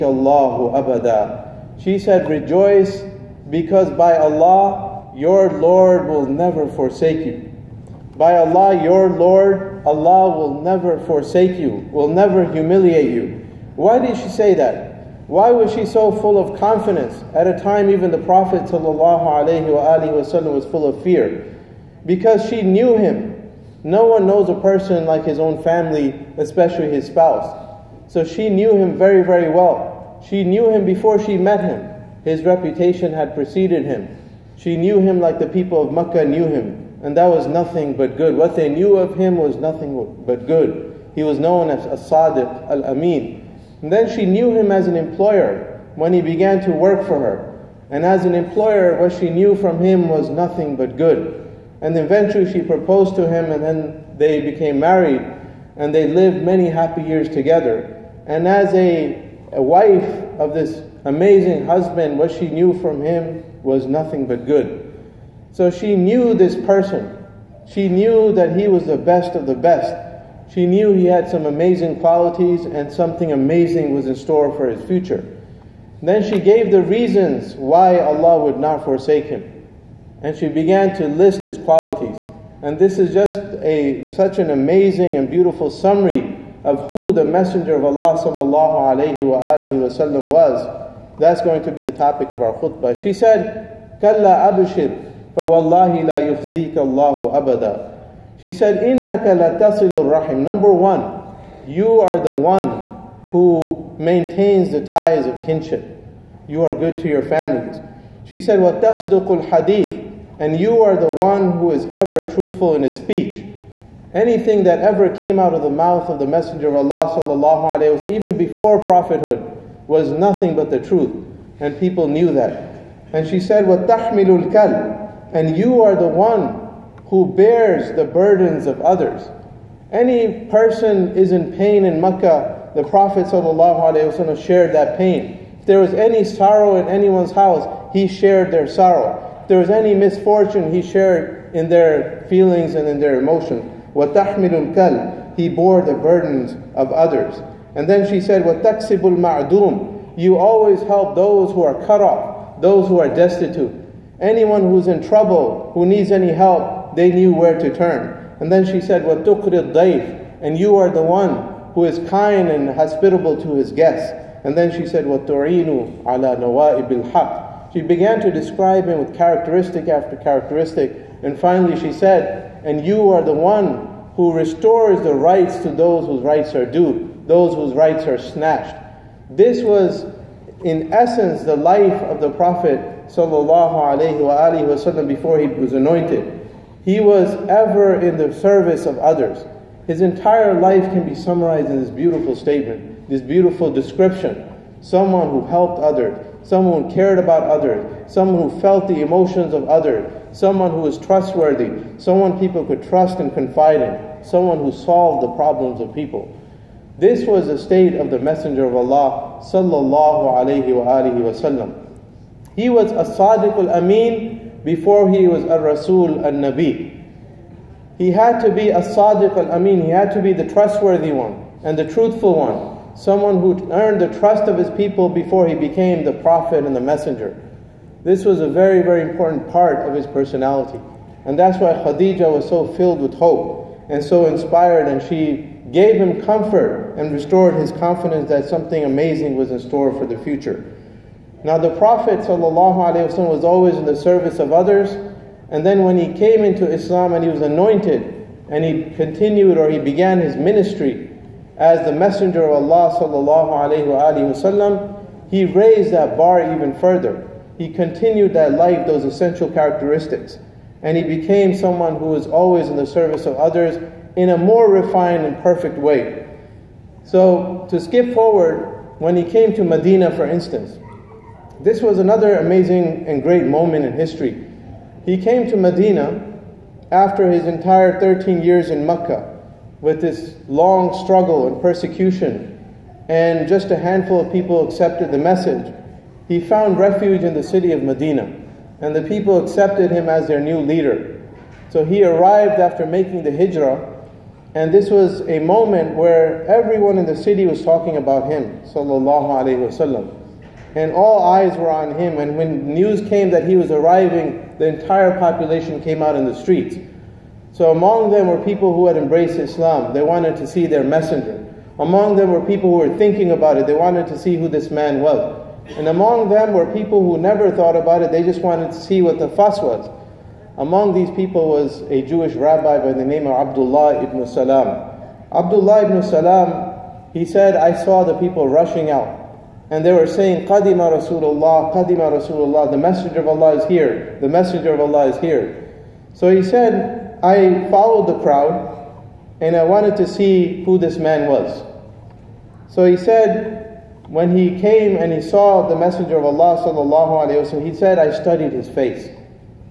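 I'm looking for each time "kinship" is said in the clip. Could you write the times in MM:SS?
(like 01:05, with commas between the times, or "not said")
01:45.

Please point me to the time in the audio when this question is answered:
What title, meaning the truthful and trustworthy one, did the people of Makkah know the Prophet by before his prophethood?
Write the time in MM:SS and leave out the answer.
00:41.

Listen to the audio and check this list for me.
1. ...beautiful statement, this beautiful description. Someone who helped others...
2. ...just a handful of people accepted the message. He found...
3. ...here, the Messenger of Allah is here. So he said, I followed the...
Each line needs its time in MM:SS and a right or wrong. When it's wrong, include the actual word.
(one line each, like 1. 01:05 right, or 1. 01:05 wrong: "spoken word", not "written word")
1. 03:11 right
2. 04:43 right
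3. 05:33 right.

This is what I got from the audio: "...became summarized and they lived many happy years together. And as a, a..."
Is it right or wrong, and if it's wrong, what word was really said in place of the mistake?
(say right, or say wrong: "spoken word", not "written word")
wrong: "married", not "summarized".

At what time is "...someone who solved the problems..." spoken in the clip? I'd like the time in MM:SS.
03:24.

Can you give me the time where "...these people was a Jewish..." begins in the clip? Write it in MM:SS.
05:20.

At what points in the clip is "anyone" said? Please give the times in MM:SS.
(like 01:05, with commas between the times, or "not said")
02:16, 02:34.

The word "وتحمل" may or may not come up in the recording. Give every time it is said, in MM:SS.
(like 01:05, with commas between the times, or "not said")
02:03, 02:23.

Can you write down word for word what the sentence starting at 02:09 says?
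Any person is in pain in Mecca, the Prophet ﷺ shared that pain.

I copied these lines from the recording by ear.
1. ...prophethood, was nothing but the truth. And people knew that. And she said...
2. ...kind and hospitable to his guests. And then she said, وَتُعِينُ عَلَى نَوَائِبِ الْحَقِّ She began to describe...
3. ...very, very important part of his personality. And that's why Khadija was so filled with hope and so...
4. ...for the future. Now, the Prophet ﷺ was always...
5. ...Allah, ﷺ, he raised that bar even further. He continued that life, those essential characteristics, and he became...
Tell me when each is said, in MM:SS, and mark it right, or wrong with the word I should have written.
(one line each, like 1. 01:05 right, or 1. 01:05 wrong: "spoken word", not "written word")
1. 01:58 right
2. 02:42 right
3. 03:48 right
4. 03:59 right
5. 04:12 right.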